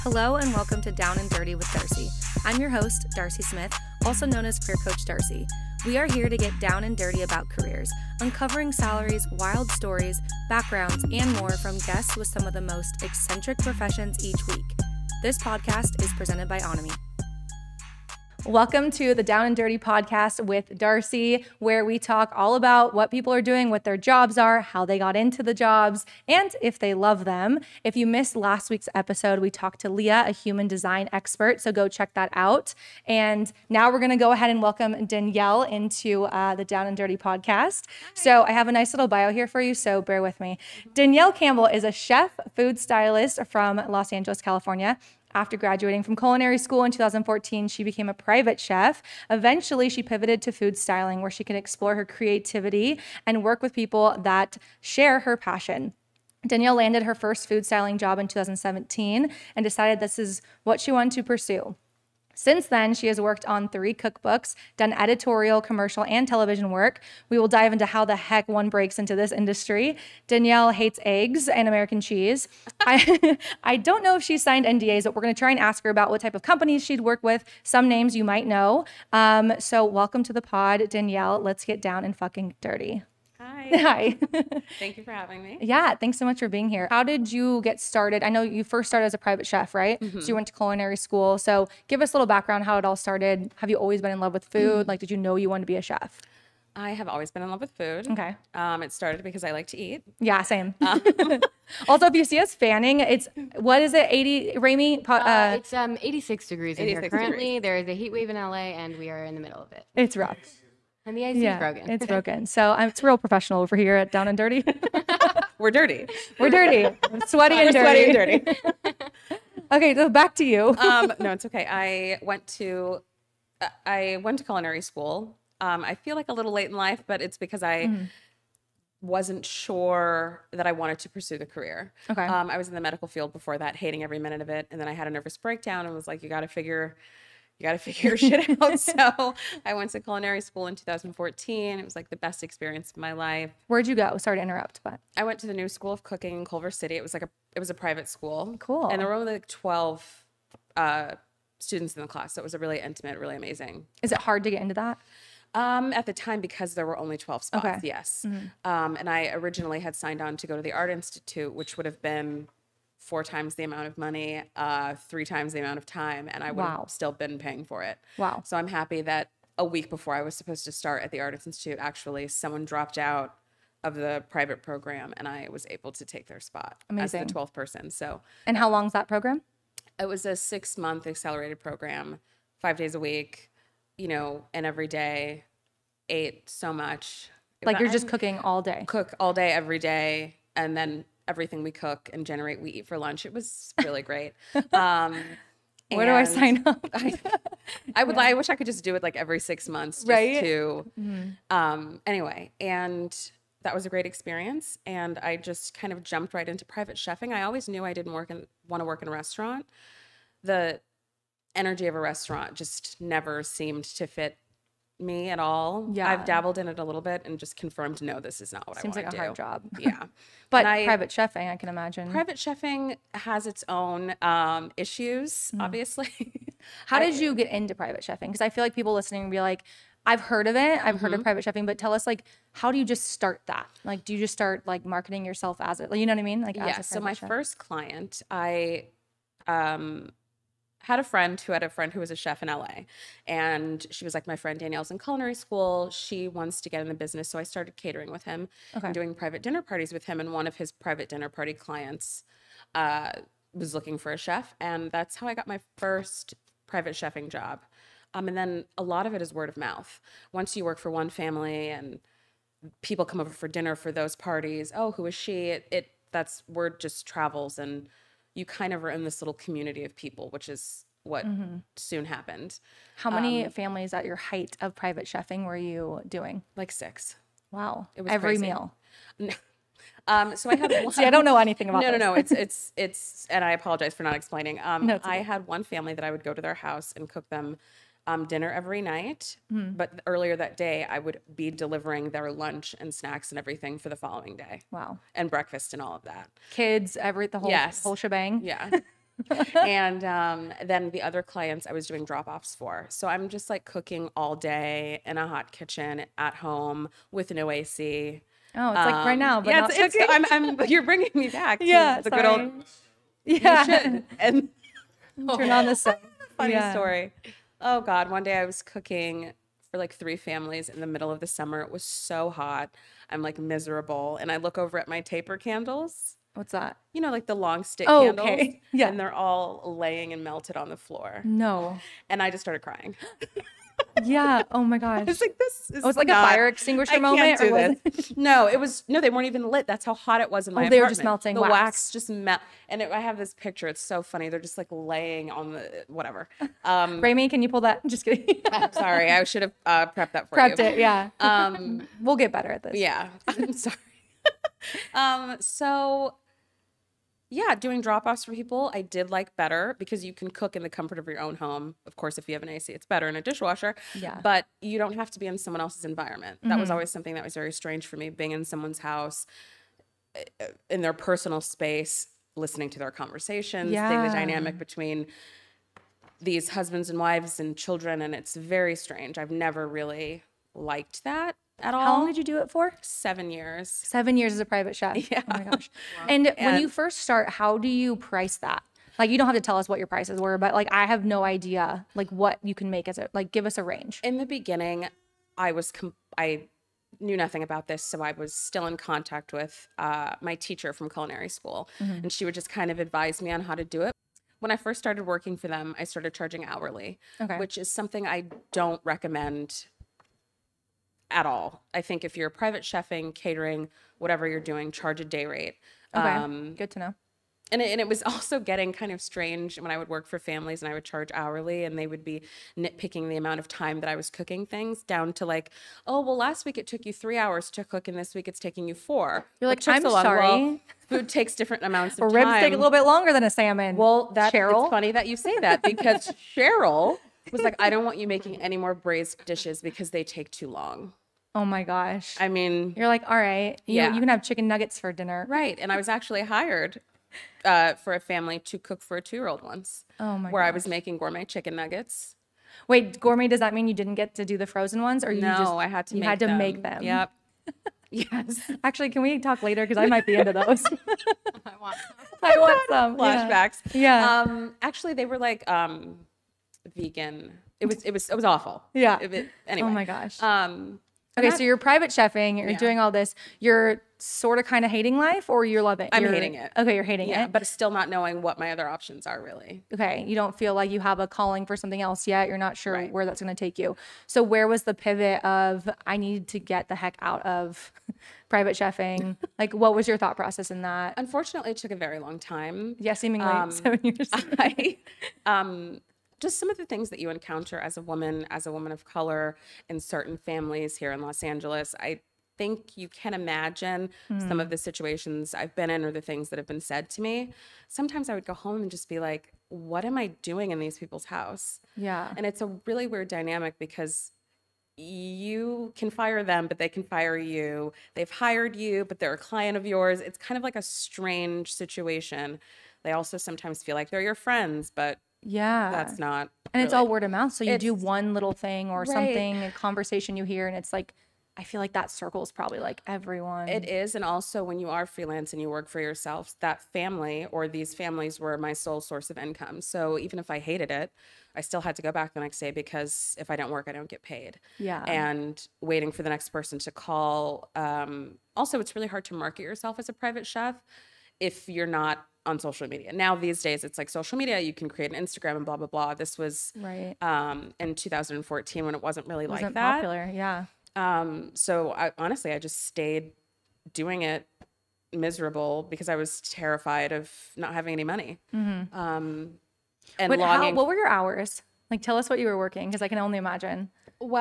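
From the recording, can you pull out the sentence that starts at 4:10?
And one of his private dinner party clients uh, was looking for a chef.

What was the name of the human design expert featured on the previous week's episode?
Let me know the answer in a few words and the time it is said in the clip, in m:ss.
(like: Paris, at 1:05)
Leah, at 0:29.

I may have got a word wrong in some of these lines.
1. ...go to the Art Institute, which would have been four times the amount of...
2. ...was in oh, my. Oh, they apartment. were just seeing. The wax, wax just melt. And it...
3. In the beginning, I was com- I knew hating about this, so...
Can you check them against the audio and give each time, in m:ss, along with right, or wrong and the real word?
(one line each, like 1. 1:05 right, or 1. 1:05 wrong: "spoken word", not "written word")
1. 2:40 right
2. 5:40 wrong: "melting", not "seeing"
3. 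6:34 wrong: "nothing", not "hating".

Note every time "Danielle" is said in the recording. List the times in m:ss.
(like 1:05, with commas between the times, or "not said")
0:35, 0:40, 0:56, 1:10, 1:20, 4:04.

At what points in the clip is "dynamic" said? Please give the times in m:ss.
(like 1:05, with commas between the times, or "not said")
6:14, 8:33.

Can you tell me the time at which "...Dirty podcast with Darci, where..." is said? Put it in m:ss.
0:19.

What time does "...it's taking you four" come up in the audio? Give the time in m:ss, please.
7:08.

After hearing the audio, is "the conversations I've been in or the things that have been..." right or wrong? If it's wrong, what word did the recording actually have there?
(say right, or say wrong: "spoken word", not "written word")
wrong: "situations", not "conversations".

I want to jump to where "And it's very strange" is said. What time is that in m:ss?
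6:17.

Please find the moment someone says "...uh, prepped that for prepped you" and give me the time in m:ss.
5:49.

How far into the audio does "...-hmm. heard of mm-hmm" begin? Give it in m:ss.
3:50.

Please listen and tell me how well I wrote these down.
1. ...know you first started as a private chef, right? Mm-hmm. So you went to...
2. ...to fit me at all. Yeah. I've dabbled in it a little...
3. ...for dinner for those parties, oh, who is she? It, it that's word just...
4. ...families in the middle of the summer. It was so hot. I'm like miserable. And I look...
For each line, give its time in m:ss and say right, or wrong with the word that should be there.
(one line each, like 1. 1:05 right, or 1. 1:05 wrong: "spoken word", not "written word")
1. 1:28 right
2. 3:33 right
3. 4:23 right
4. 5:20 right.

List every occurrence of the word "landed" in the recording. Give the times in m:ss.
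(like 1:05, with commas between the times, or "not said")
0:56.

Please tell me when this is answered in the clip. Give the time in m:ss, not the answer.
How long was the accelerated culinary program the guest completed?
3:00.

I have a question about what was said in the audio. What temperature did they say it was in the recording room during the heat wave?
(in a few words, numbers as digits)
86 degrees.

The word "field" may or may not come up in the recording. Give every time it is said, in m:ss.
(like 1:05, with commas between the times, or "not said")
2:13.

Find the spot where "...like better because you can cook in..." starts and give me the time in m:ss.
5:59.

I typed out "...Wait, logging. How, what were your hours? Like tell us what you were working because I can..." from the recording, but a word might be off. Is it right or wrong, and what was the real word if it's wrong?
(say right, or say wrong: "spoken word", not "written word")
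right.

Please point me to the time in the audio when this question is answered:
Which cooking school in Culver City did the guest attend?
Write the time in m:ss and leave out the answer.
2:25.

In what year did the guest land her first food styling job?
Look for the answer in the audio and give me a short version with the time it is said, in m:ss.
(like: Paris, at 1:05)
2017, at 0:58.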